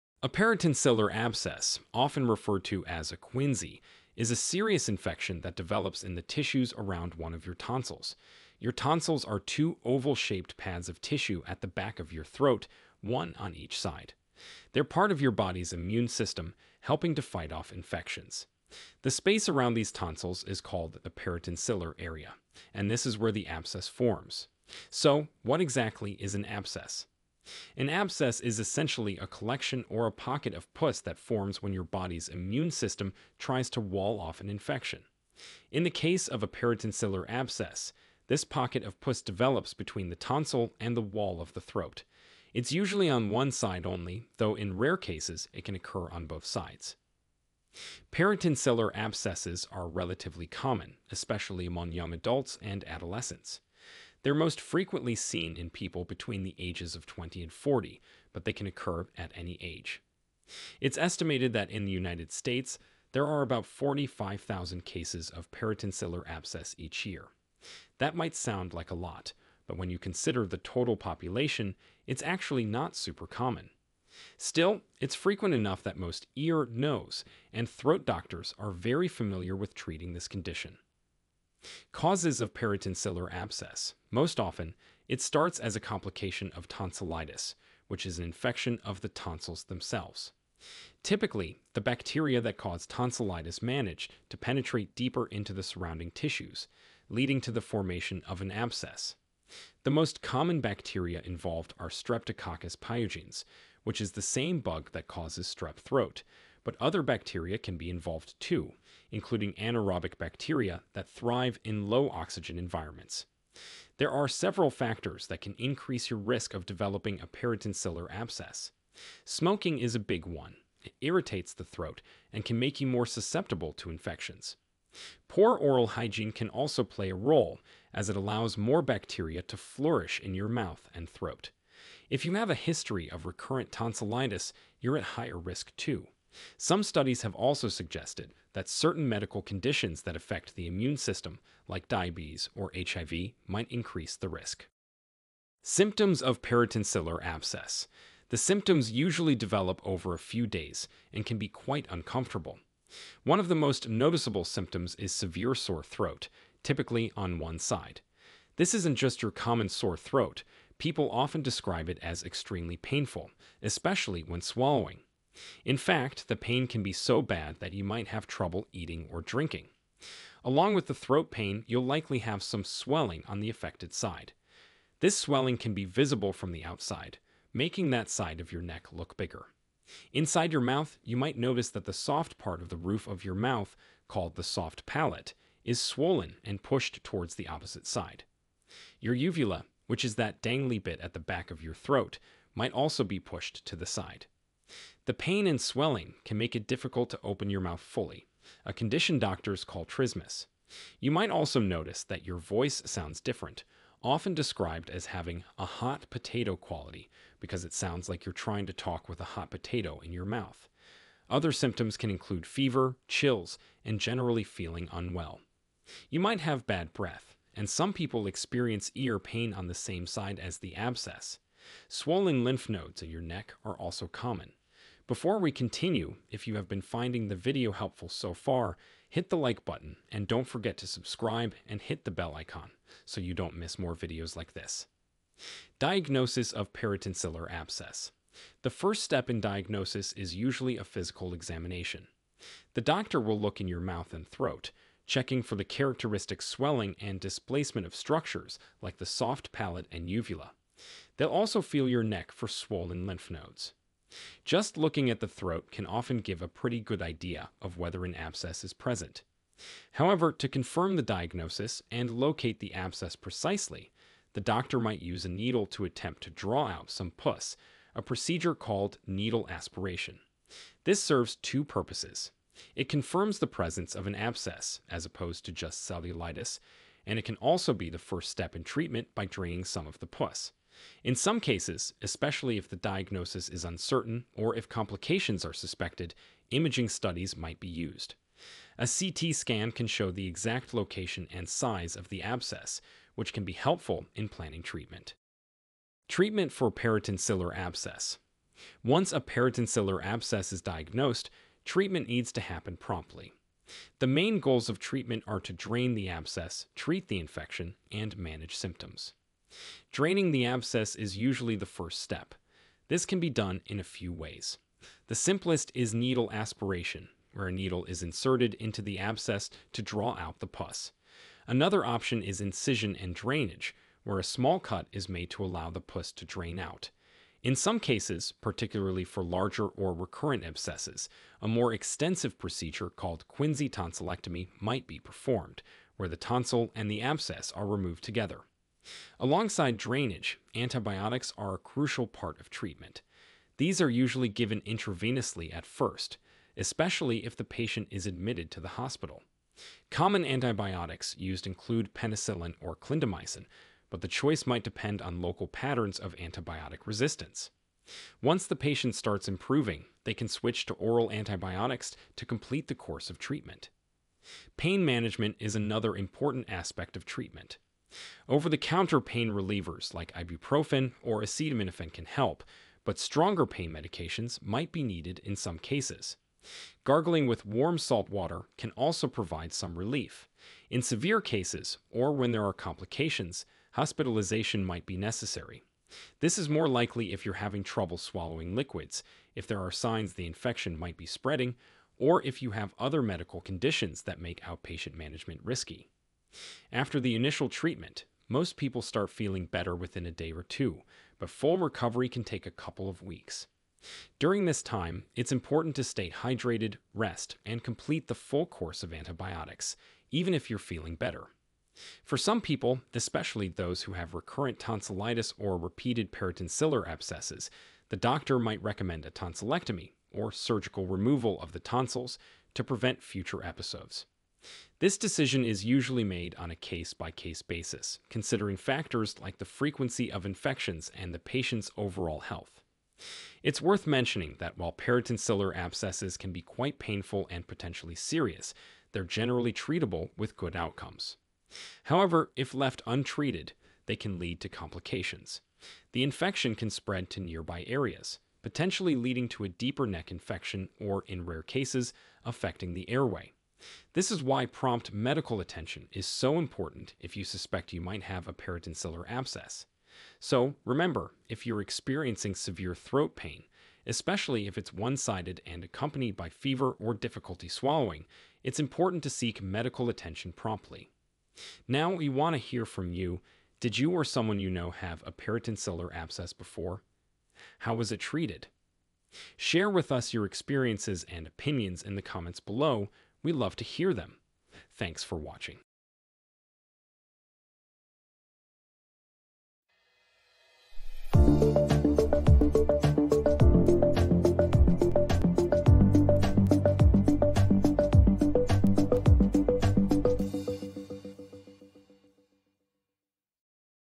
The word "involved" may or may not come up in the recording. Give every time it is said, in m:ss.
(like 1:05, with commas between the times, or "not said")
1:41, 1:47.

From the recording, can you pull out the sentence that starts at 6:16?
Gargling with warm salt water can also provide some relief.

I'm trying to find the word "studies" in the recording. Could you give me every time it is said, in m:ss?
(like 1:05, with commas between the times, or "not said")
2:16, 4:46.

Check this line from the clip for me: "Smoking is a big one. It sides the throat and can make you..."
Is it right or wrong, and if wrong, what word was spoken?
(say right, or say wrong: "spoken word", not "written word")
wrong: "irritates", not "sides".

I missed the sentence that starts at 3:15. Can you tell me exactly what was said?
The pain and swelling can make it difficult to open your mouth fully, a condition doctors call trismus.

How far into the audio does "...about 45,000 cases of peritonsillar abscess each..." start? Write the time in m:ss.
1:03.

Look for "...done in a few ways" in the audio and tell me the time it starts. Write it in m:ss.
5:13.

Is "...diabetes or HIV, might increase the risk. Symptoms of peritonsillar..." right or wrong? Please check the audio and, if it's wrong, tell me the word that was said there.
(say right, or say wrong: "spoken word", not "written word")
right.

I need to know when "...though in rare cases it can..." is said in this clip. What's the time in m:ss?
0:44.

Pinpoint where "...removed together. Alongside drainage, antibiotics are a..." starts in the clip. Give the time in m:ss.
5:37.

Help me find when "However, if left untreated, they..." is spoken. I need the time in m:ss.
7:21.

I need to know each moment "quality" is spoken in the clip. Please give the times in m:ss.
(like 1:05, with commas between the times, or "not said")
3:26.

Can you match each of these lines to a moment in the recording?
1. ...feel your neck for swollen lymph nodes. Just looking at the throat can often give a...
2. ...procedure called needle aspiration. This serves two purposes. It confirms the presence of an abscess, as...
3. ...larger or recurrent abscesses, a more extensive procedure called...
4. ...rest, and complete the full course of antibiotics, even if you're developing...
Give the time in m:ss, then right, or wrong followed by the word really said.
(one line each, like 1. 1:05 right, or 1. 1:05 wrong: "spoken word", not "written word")
1. 4:11 right
2. 4:28 right
3. 5:29 right
4. 6:46 wrong: "feeling", not "developing".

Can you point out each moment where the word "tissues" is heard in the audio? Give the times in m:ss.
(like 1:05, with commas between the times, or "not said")
0:06, 0:11, 1:36.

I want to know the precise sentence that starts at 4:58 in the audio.
Once a peritonsillar abscess is diagnosed, treatment needs to happen promptly.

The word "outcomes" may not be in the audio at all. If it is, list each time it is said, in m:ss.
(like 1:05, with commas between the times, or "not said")
7:20.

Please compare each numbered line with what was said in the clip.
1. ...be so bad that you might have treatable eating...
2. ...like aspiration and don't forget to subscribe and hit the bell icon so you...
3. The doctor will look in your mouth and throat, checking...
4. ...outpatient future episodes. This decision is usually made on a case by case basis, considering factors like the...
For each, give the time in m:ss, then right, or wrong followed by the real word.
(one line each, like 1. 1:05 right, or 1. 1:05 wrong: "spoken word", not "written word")
1. 2:46 wrong: "trouble", not "treatable"
2. 3:49 wrong: "button", not "aspiration"
3. 4:02 right
4. 7:02 wrong: "prevent", not "outpatient".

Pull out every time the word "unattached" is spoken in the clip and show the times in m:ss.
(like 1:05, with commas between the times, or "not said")
not said.